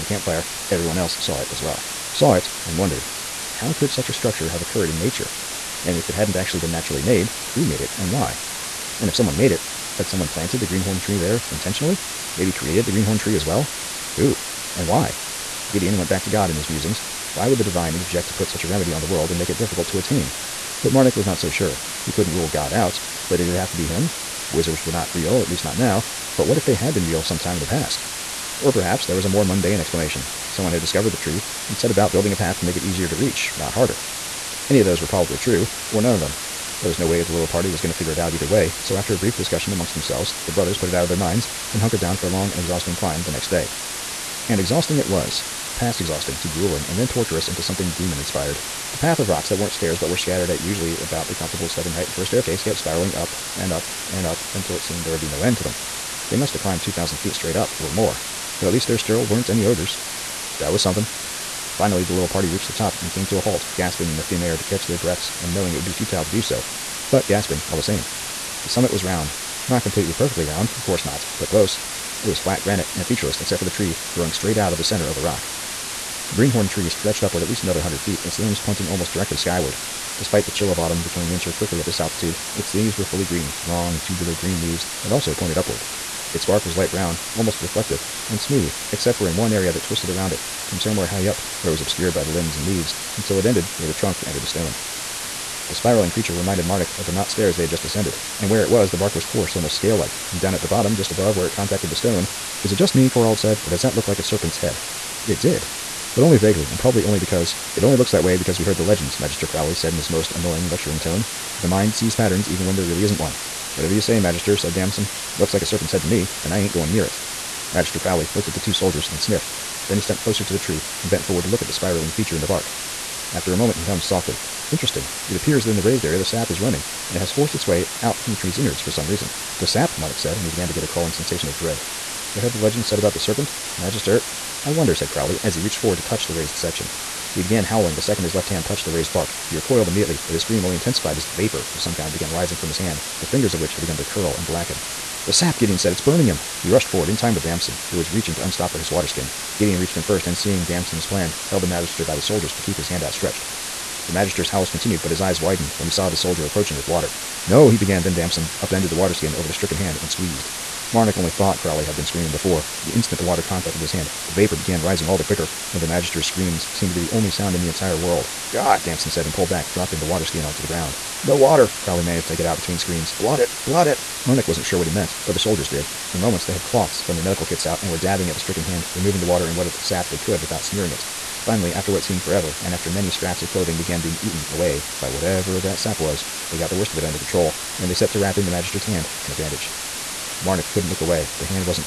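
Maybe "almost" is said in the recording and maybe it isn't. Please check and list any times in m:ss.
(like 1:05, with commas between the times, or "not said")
1:18, 1:27, 1:39.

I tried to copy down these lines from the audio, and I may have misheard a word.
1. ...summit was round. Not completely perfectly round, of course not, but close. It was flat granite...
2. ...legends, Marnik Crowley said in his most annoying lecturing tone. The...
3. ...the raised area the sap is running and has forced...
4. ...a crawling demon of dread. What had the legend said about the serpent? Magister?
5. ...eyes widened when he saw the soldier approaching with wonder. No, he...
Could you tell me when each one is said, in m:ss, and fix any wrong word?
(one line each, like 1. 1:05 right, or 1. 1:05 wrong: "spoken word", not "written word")
1. 1:08 right
2. 1:48 wrong: "Magister", not "Marnik"
3. 2:05 right
4. 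2:10 wrong: "sensation", not "demon"
5. 2:35 wrong: "water", not "wonder".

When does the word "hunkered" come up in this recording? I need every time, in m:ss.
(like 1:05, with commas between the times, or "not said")
0:41.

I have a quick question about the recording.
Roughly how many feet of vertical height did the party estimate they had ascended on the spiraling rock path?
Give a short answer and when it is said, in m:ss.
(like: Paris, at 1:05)
2,000 feet, at 0:56.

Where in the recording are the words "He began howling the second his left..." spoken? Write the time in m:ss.
2:17.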